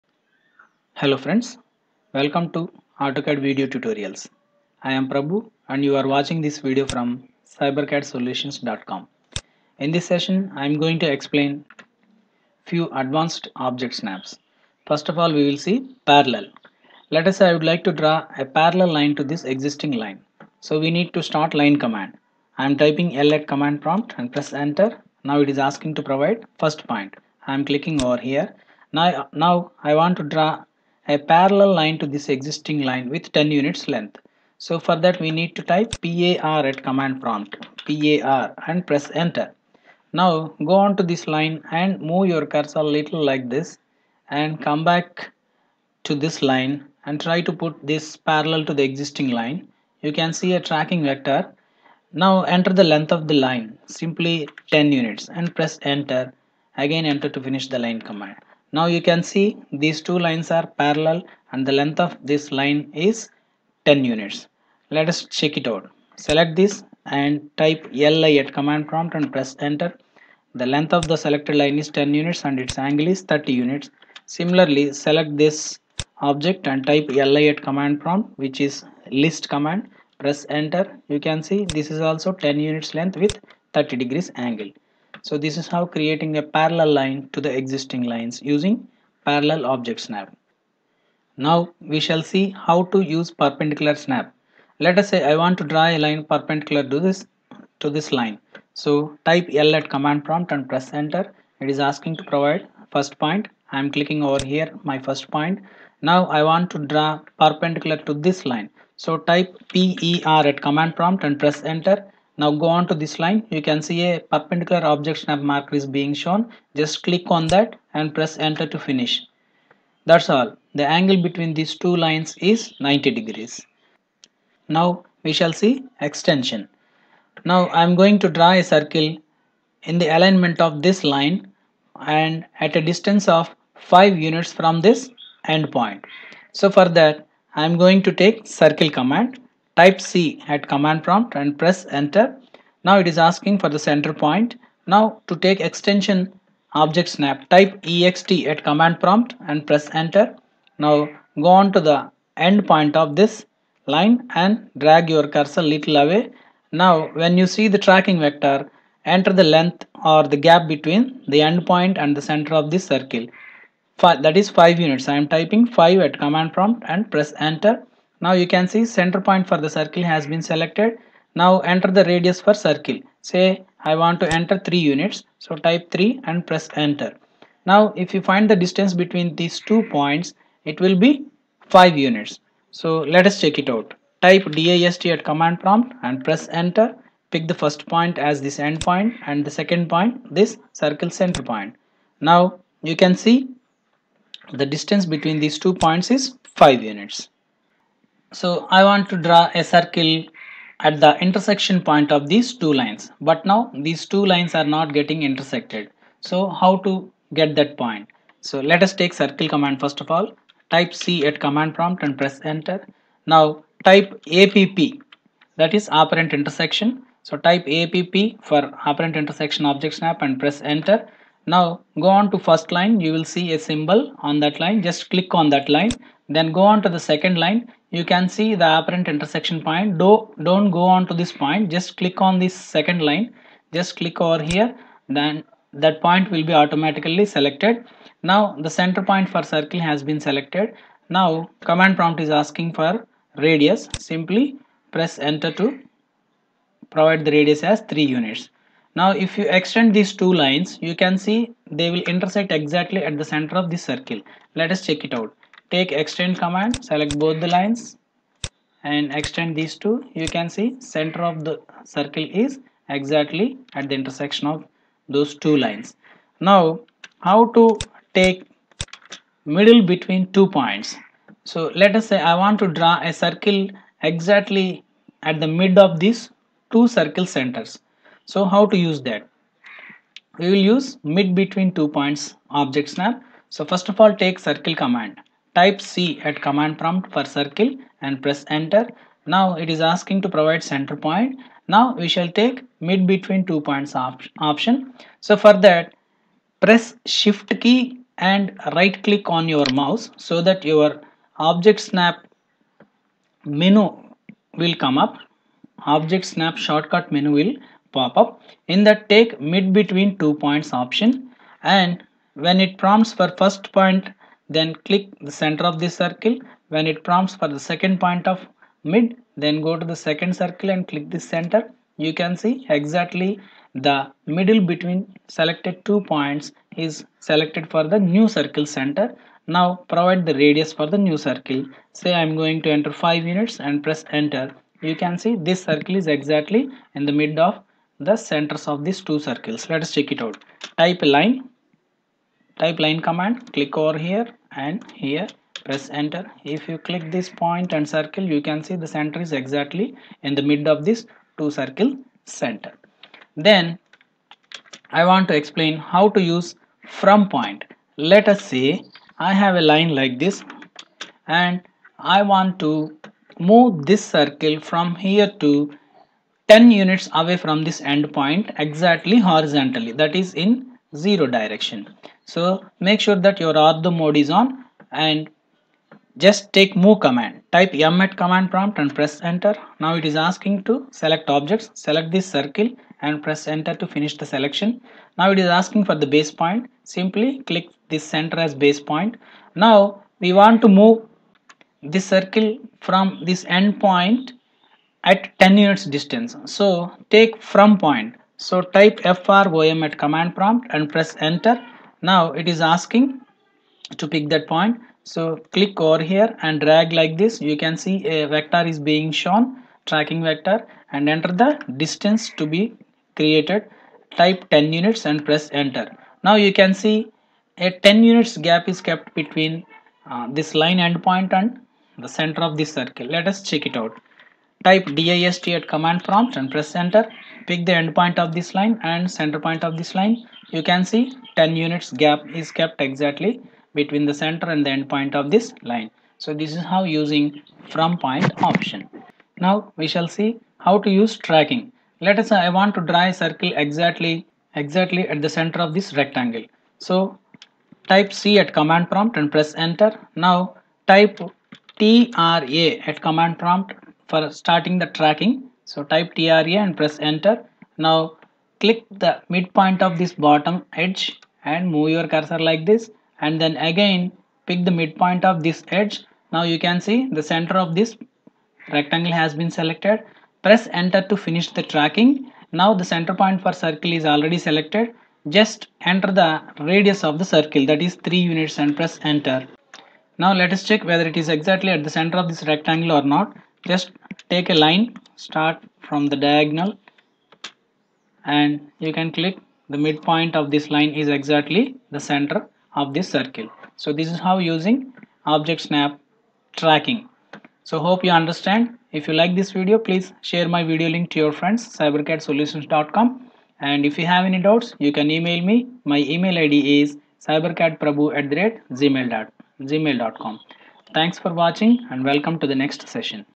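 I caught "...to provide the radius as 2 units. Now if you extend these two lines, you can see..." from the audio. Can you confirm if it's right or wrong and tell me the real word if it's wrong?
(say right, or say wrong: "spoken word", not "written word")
wrong: "3", not "2".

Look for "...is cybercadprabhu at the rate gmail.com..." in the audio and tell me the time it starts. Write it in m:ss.
8:26.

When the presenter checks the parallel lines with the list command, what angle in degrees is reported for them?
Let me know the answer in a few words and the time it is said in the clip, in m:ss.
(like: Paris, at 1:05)
30, at 1:23.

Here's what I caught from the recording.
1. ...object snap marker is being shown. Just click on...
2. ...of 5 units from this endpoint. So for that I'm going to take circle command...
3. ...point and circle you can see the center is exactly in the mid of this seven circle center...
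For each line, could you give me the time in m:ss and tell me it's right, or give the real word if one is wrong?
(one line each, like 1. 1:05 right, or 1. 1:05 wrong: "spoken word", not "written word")
1. 1:54 right
2. 2:13 right
3. 5:47 wrong: "two", not "seven".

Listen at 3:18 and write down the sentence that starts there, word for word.
So I want to draw a circle at the intersection point of these two lines.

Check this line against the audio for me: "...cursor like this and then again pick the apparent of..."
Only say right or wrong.
wrong.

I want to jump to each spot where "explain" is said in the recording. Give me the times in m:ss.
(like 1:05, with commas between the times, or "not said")
0:11, 5:55.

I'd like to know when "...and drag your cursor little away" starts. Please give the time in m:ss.
2:34.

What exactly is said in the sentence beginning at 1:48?
So type PER at command prompt and press enter.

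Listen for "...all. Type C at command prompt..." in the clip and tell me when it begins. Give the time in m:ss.
3:30.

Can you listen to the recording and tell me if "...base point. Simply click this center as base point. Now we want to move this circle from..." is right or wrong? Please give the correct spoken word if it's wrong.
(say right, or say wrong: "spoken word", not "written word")
right.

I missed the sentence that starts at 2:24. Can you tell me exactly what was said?
Now to take extension object snap type ext at command prompt and press enter.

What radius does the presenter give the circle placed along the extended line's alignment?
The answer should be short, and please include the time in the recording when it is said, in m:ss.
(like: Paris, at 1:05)
3, at 2:55.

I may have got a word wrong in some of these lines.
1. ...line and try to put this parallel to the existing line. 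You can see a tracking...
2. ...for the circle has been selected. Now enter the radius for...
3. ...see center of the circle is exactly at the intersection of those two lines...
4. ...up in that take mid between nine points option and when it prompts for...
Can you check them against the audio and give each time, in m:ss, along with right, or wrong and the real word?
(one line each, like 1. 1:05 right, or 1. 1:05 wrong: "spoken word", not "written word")
1. 0:46 right
2. 2:49 right
3. 4:20 right
4. 5:08 wrong: "two", not "nine".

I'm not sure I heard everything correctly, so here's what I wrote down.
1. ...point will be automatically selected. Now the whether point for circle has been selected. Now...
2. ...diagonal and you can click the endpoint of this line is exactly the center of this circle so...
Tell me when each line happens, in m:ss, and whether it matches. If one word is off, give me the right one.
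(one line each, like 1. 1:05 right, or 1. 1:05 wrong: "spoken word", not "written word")
1. 3:56 wrong: "center", not "whether"
2. 8:06 wrong: "midpoint", not "endpoint".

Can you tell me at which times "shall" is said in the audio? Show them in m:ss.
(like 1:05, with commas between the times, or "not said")
1:31, 2:05, 4:52, 7:19.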